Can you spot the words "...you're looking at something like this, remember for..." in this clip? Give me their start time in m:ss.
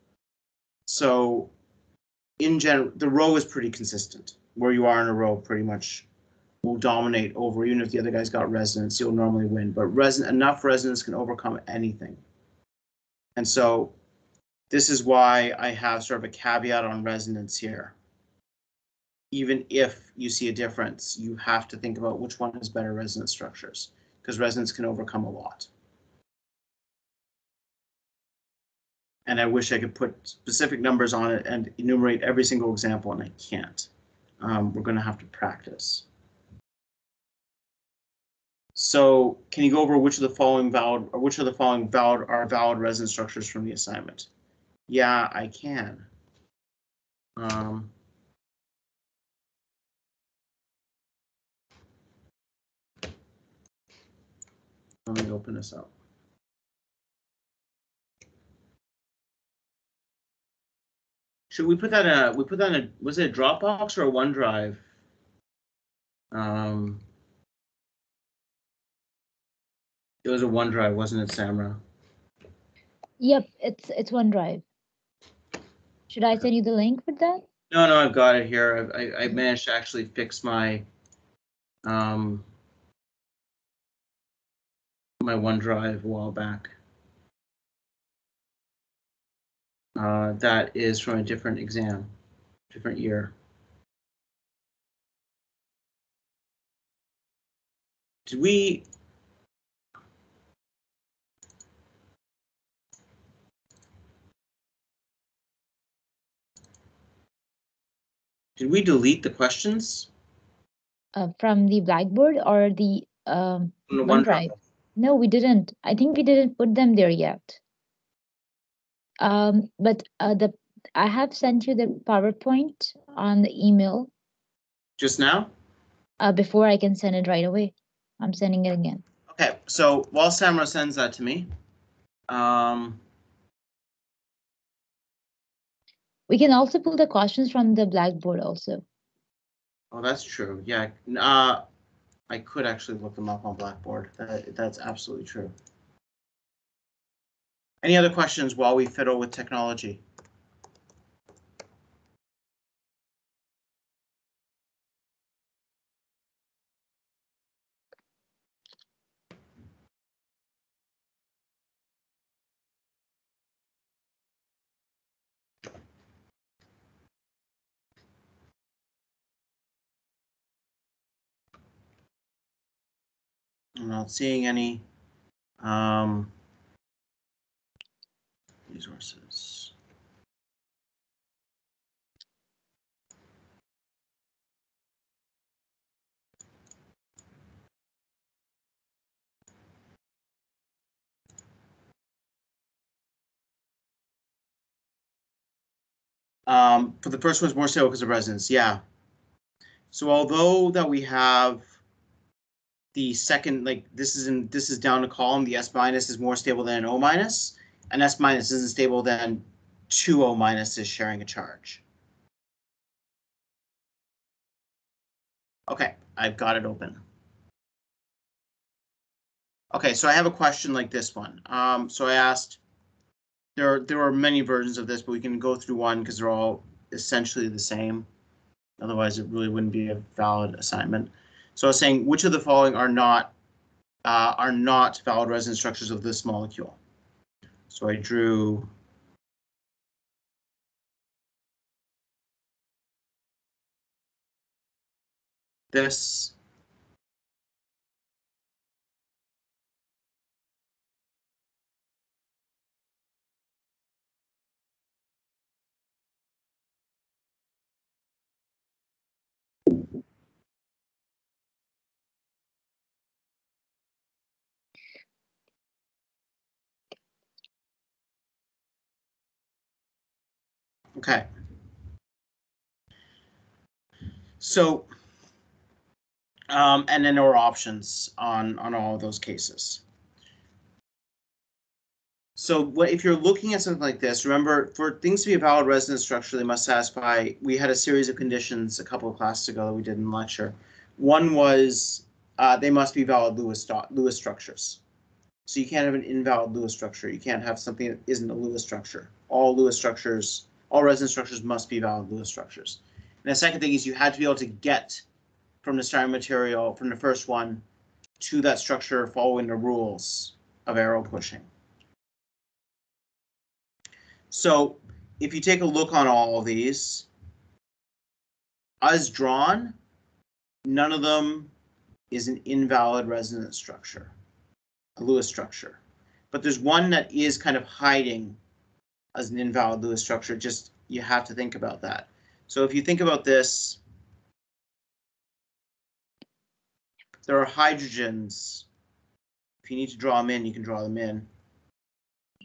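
4:43.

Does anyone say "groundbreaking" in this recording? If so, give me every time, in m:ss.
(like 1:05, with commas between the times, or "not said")
not said.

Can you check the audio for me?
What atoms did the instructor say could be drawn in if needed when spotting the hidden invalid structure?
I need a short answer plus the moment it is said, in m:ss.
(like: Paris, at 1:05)
Hydrogens, at 5:37.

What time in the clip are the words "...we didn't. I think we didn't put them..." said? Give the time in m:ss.
1:55.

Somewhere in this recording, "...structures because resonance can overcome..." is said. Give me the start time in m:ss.
0:23.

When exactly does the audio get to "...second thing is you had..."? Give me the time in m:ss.
5:03.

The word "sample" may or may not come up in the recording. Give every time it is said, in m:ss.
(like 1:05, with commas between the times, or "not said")
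not said.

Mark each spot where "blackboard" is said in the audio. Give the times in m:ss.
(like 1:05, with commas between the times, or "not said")
1:51, 2:17, 2:23.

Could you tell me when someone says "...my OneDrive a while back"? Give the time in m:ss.
1:25.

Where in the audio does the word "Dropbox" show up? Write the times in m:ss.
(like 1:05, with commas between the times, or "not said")
1:03.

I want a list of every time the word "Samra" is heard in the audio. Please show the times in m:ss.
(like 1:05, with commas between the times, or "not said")
1:11, 2:10.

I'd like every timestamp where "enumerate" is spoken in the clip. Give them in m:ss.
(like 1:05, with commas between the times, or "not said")
0:31.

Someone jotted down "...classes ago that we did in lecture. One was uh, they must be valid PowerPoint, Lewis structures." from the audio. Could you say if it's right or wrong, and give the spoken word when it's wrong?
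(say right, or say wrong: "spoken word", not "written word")
wrong: "Lewis", not "PowerPoint".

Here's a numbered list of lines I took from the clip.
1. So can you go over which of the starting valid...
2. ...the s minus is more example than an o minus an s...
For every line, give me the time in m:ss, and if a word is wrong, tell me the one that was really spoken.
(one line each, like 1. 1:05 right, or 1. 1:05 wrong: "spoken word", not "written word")
1. 0:38 wrong: "following", not "starting"
2. 3:25 wrong: "stable", not "example".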